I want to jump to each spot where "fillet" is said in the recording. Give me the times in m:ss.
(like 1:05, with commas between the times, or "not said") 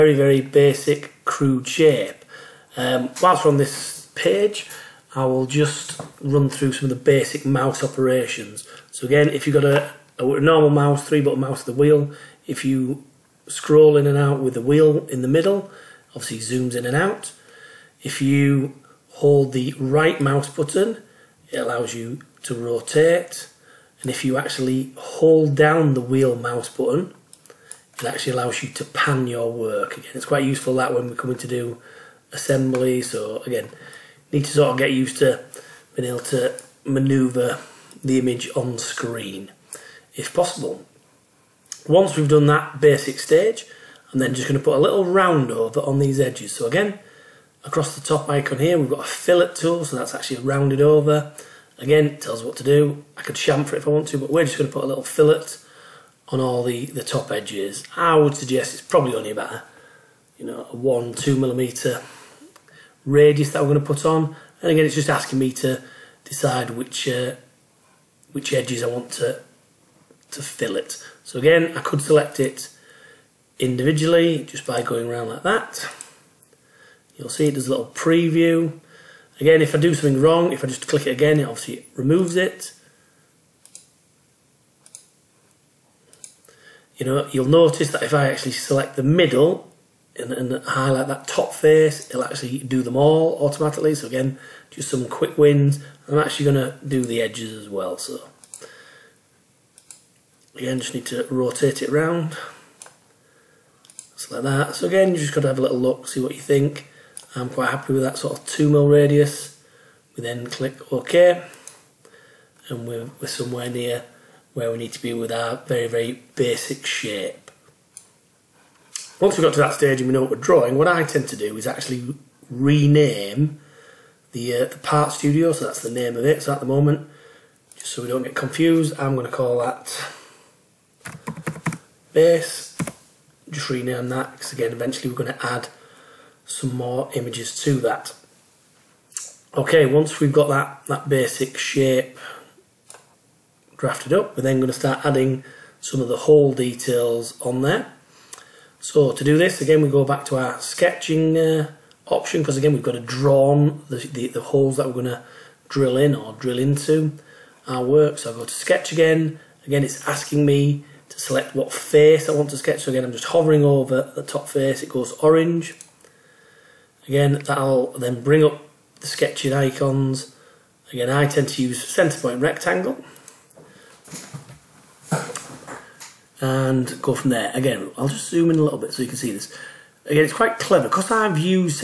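0:49, 0:55, 1:10.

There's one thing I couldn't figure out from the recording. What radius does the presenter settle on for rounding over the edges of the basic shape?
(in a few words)
2 mm.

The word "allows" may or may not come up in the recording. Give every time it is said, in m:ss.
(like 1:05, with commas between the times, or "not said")
0:21, 0:28.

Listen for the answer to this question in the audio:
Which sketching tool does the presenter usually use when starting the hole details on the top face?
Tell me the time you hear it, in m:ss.
2:51.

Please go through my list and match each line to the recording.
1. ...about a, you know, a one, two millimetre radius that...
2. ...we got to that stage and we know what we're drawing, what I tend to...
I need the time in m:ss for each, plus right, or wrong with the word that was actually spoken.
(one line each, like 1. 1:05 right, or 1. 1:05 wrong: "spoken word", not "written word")
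1. 0:59 right
2. 1:59 right.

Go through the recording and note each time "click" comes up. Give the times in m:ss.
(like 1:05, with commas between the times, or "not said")
1:20, 1:50.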